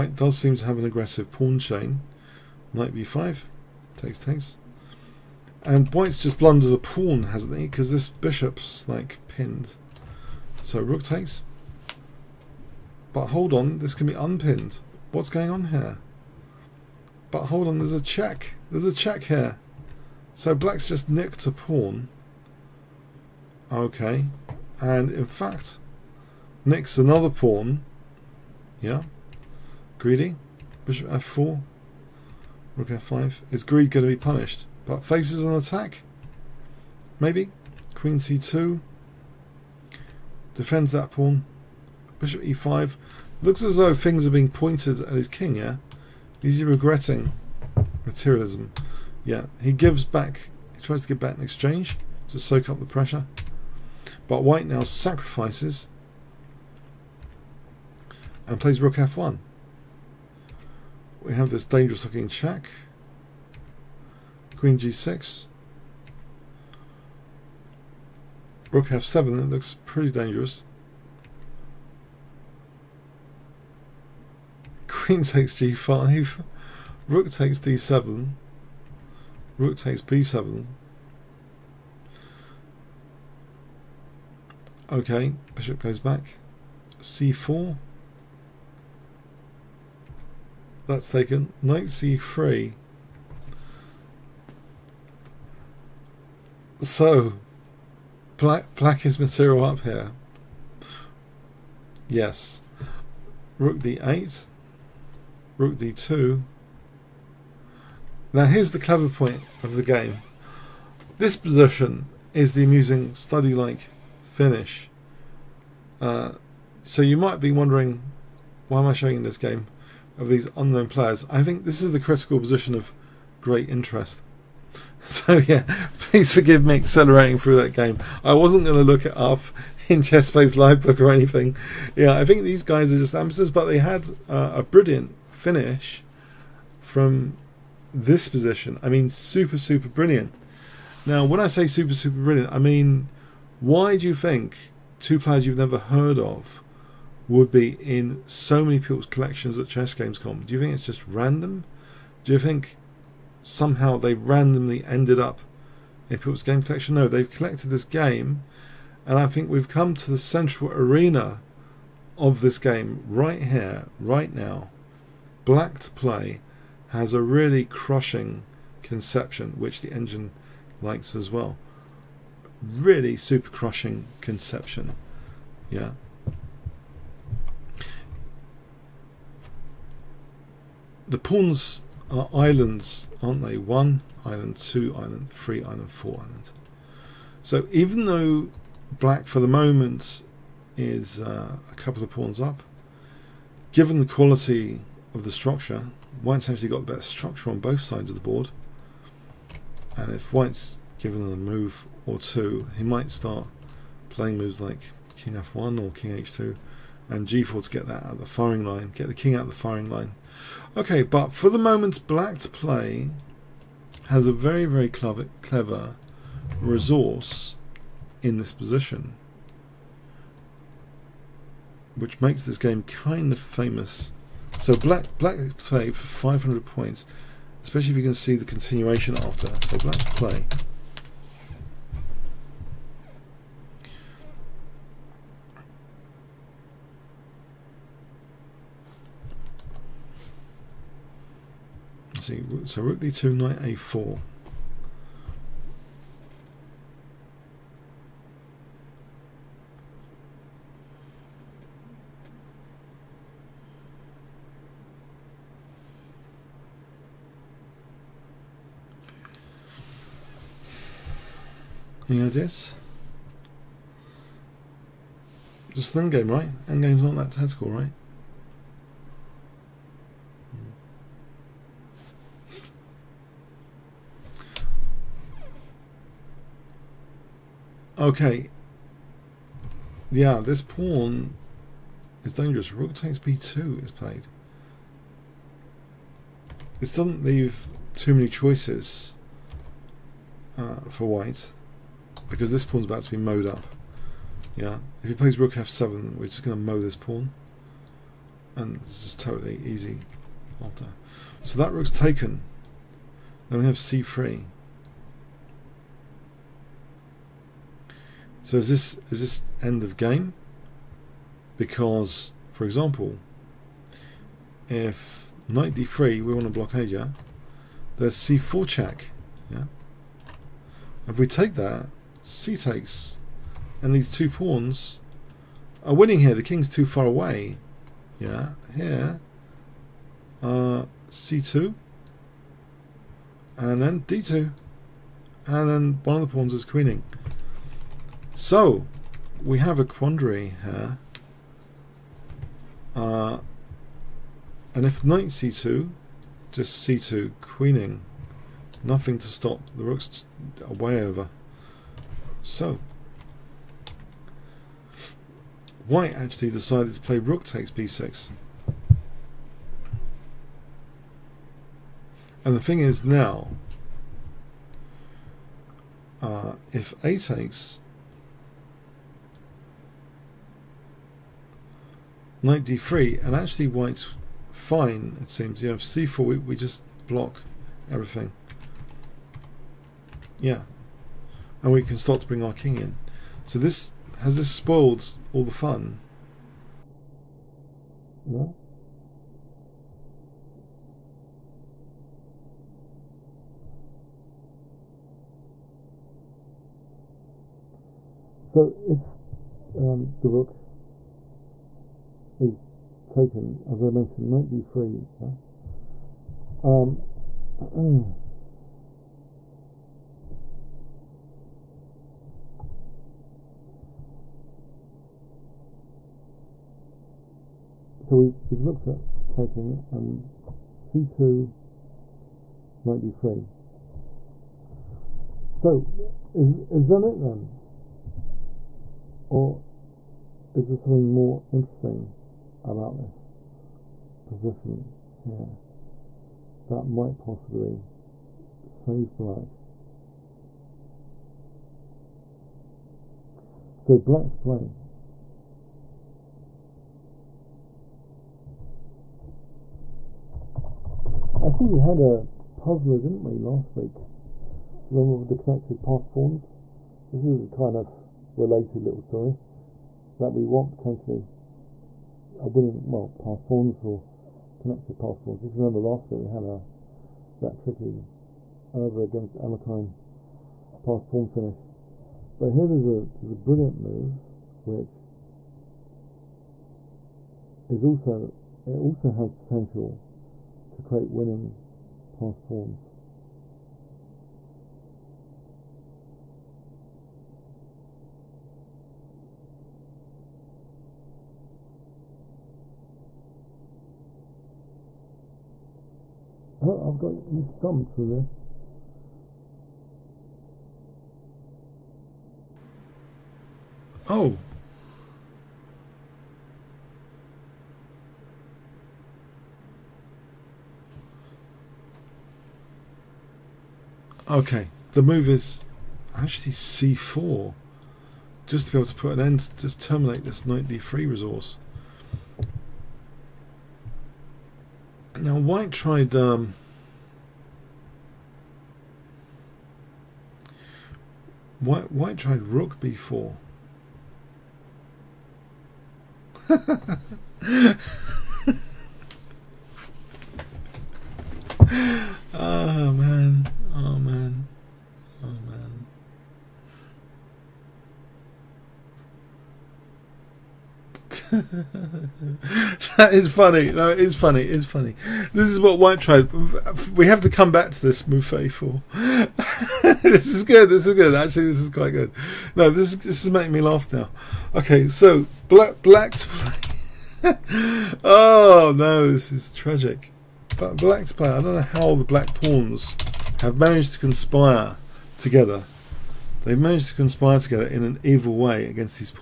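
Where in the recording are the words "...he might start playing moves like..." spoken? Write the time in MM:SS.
03:22.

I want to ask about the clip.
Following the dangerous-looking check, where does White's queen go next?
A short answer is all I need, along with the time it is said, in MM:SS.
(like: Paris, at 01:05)
Queen g6, at 01:04.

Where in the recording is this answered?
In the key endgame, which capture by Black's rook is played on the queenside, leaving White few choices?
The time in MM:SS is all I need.
04:42.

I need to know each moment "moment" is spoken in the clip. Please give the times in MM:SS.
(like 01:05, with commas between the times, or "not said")
03:09, 03:31.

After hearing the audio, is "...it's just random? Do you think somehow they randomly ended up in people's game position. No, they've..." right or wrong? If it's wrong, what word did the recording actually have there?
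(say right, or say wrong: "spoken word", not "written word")
wrong: "collection", not "position".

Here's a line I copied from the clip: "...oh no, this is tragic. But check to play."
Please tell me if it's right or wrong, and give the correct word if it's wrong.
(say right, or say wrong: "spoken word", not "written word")
wrong: "black", not "check".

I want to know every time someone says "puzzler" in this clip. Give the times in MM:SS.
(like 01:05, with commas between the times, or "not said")
07:32.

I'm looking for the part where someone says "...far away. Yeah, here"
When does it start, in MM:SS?
05:26.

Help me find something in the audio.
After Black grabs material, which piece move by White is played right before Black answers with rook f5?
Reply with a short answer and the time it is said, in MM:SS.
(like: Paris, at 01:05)
Bishop f4, at 00:30.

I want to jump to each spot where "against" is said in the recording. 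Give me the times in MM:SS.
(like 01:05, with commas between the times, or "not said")
07:49, 09:38.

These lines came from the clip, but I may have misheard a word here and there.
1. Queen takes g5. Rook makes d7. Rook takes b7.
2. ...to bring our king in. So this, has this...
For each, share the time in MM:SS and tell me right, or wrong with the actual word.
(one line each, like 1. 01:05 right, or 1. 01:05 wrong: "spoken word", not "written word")
1. 01:14 wrong: "takes", not "makes"
2. 06:22 right.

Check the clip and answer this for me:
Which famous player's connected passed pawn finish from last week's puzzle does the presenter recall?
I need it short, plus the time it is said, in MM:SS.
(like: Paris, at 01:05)
Alekhine, at 07:49.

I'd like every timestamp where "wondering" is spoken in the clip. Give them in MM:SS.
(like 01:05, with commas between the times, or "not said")
01:57.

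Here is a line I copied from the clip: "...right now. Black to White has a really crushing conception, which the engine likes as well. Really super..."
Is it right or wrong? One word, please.
wrong.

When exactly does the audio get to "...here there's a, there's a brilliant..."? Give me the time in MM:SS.
07:52.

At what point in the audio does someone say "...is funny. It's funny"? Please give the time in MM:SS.
09:13.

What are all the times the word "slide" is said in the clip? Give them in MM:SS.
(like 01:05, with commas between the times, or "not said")
not said.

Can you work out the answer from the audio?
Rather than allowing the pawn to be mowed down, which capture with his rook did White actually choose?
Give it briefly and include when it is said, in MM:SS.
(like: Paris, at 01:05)
Rook takes b6, at 05:57.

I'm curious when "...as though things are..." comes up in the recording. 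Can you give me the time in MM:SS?
00:43.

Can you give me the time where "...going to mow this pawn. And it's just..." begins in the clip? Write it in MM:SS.
04:56.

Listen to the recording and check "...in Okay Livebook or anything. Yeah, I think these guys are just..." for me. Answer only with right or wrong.
wrong.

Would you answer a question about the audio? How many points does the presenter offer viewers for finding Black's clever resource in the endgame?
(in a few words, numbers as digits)
500.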